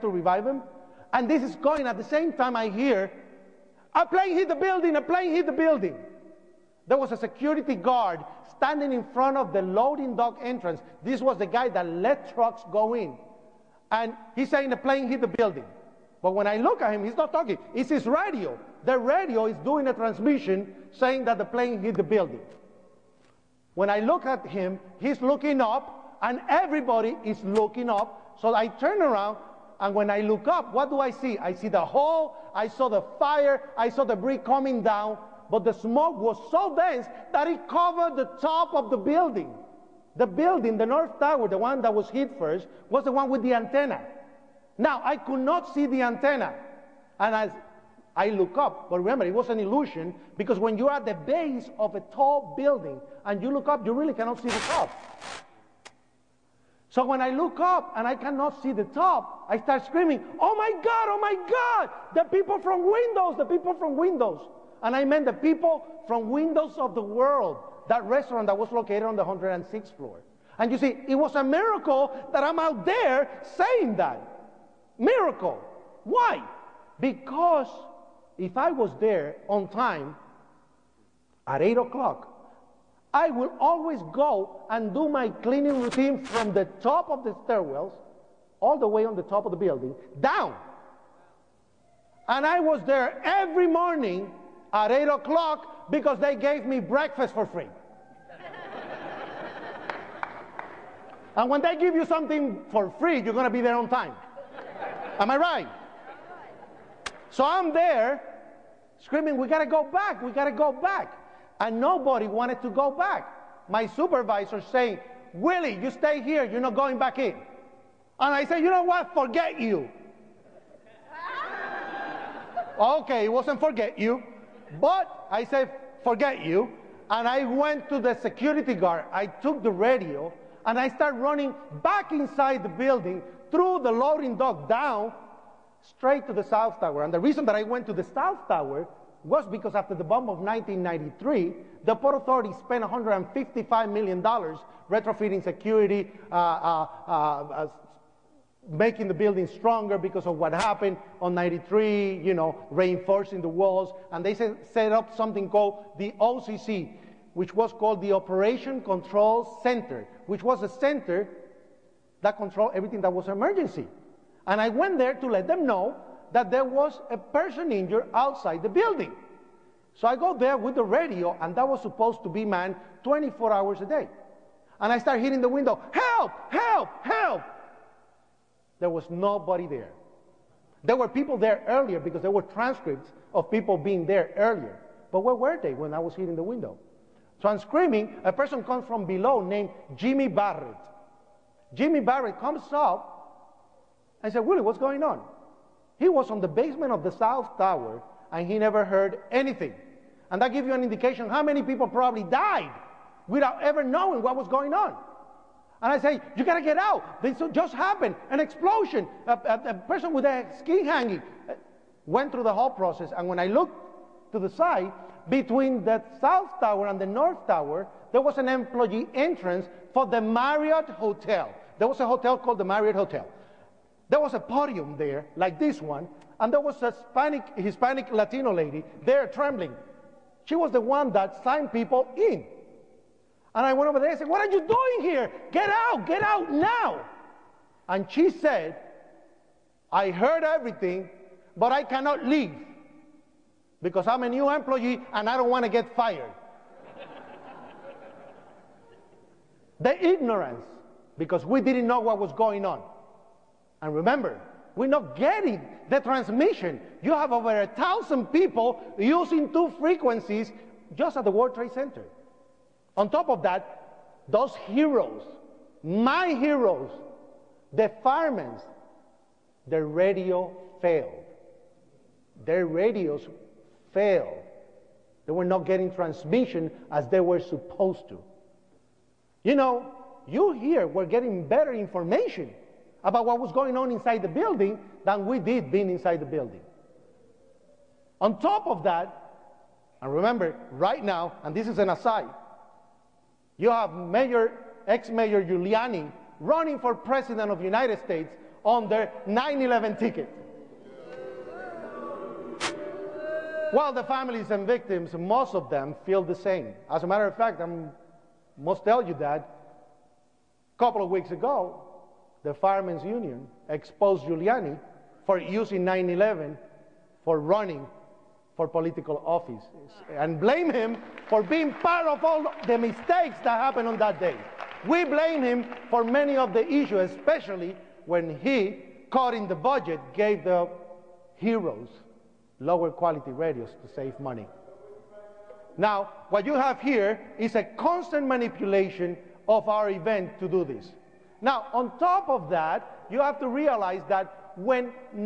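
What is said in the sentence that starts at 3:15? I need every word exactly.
He was on the basement of the South Tower and he never heard anything.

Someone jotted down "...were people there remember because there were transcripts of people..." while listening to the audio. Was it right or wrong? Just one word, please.
wrong.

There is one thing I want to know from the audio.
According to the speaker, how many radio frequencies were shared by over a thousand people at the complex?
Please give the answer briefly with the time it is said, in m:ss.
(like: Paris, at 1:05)
2, at 4:19.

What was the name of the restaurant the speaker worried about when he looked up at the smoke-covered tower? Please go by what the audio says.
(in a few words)
Windows of the World.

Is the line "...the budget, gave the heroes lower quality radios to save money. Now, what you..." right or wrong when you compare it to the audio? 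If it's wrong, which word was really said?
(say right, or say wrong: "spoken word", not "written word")
right.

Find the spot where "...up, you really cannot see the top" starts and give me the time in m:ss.
0:53.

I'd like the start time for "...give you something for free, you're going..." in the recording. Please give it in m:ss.
1:41.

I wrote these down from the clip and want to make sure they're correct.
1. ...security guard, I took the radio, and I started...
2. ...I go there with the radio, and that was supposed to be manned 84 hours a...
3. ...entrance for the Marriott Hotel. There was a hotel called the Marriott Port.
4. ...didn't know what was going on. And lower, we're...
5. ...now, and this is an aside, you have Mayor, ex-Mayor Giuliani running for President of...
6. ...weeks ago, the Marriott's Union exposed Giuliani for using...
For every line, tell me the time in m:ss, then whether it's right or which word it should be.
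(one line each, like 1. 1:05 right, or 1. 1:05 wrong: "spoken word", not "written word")
1. 2:08 right
2. 2:50 wrong: "24", not "84"
3. 3:39 wrong: "Hotel", not "Port"
4. 4:11 wrong: "remember", not "lower"
5. 4:51 right
6. 5:11 wrong: "Firemen", not "Marriott".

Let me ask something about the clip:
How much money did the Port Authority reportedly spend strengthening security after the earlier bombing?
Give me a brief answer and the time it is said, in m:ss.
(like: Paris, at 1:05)
$155 million, at 2:22.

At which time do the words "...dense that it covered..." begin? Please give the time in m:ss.
0:36.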